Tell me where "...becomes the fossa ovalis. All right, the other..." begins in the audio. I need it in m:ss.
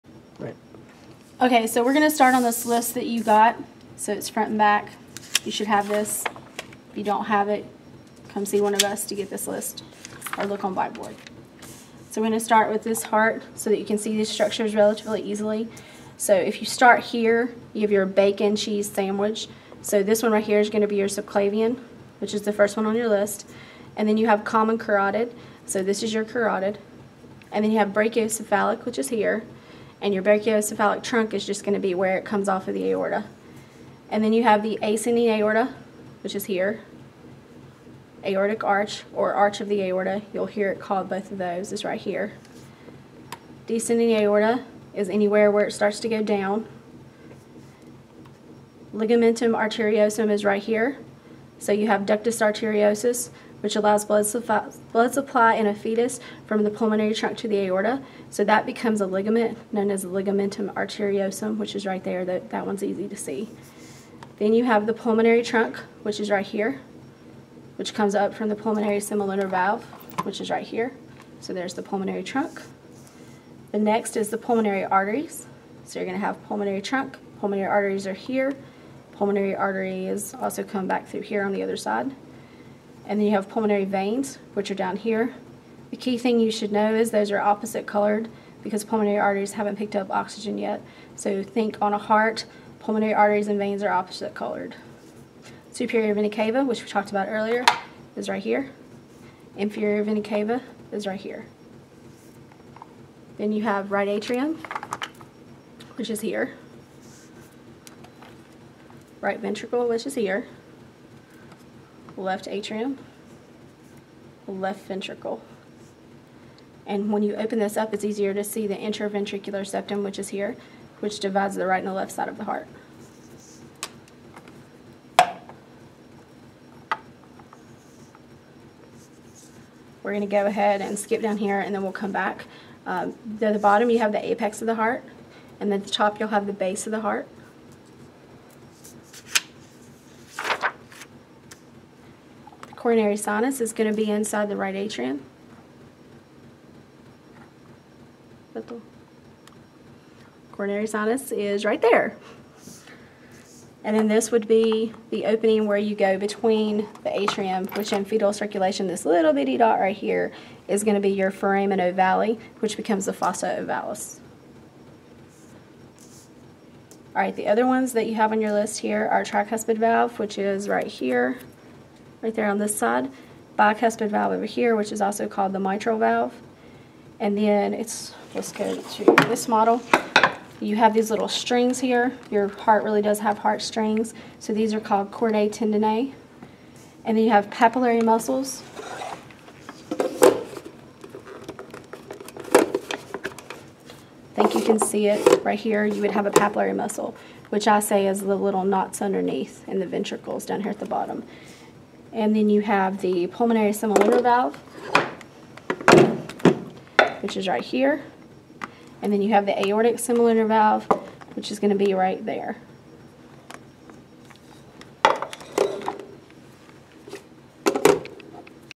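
2:42.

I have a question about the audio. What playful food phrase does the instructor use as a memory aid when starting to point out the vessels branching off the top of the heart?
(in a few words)
bacon cheese sandwich.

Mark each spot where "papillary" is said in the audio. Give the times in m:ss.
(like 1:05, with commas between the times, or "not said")
3:07, 3:16.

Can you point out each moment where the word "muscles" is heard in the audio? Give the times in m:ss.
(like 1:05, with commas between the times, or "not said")
3:08, 3:16.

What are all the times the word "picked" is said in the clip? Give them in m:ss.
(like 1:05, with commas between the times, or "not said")
1:29.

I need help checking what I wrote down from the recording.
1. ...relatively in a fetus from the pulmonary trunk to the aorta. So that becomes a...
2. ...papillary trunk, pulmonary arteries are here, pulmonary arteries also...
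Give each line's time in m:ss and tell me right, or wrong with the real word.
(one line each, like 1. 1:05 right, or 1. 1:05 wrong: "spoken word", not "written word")
1. 0:55 wrong: "supply", not "relatively"
2. 1:16 wrong: "pulmonary", not "papillary".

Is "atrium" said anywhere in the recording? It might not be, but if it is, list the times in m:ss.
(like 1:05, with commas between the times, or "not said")
1:44, 1:52, 2:24, 2:37.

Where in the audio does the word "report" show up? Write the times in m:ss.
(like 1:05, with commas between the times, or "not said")
not said.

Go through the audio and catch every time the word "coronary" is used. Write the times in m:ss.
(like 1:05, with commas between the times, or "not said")
2:22, 2:30.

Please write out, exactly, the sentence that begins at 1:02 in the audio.
That, that one's easy to see.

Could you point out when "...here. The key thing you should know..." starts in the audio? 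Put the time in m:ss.
1:24.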